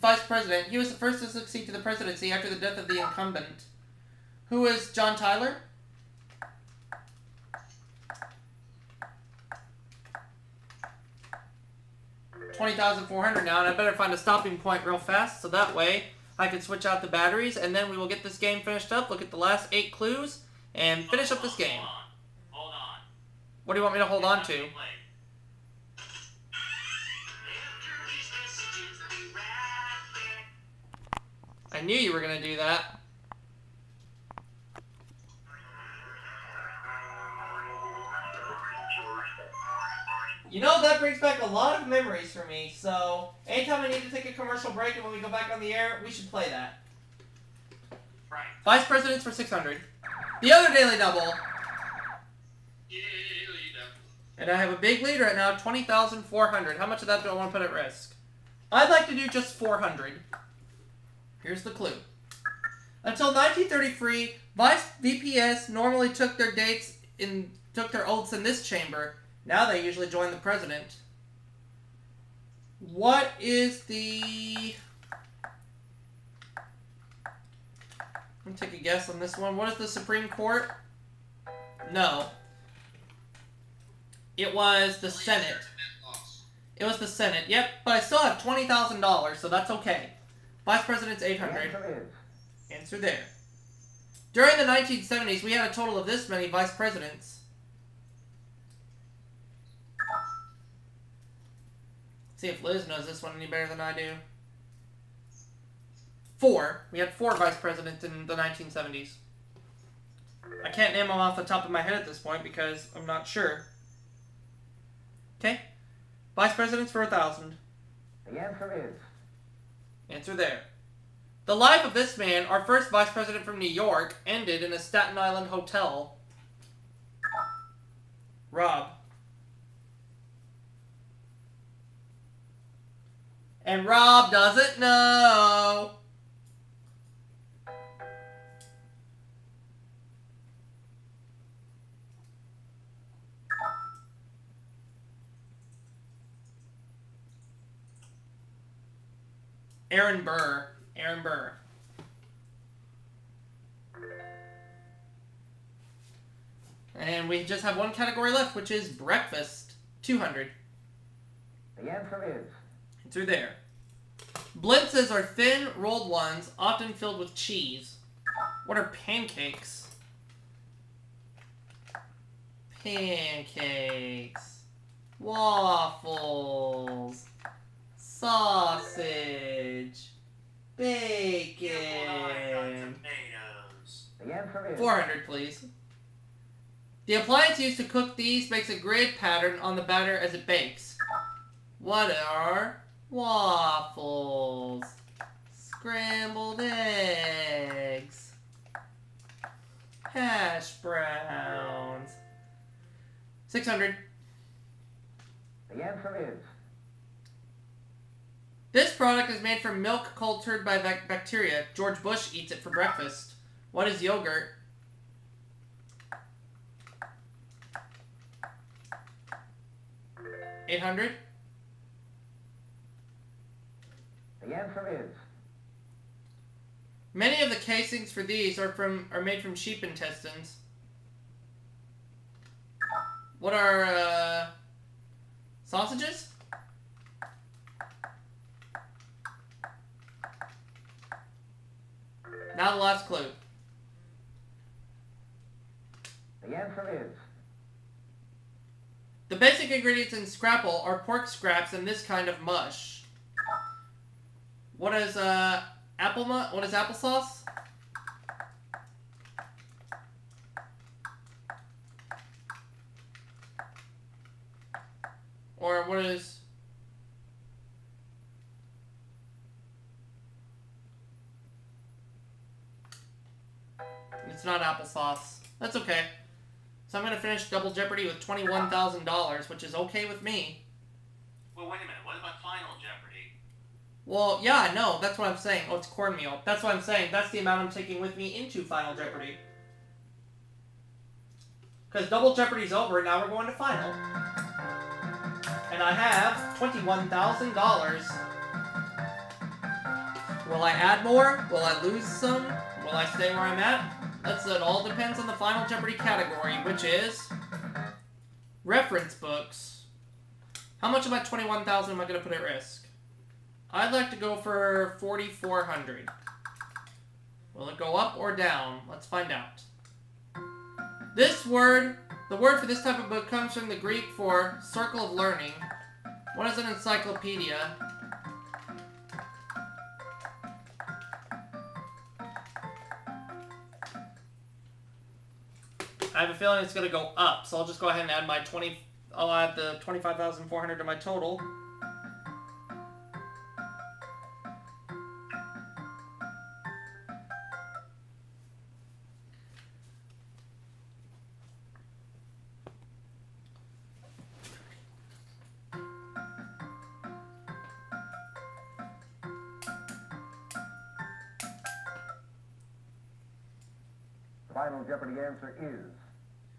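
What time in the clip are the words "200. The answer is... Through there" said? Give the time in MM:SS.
02:40.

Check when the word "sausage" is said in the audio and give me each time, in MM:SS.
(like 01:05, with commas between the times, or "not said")
02:58, 03:55.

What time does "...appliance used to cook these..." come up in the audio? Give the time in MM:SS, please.
03:07.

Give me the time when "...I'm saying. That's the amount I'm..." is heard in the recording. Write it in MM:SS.
04:46.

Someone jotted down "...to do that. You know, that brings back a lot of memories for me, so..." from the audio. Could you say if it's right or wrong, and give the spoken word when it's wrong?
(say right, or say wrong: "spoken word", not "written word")
right.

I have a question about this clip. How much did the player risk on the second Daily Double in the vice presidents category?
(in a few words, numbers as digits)
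400.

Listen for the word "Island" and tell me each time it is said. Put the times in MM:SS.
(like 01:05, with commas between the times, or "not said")
02:05.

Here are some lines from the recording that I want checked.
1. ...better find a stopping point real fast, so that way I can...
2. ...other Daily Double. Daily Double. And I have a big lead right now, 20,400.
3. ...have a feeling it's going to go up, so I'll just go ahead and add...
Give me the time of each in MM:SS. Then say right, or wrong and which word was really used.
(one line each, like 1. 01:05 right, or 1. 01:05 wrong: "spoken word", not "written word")
1. 00:13 right
2. 00:50 right
3. 05:36 right.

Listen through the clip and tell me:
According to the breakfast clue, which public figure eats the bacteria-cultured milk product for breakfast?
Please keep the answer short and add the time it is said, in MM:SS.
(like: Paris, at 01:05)
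George Bush, at 03:31.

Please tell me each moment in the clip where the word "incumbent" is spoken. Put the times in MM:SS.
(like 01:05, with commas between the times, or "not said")
00:02.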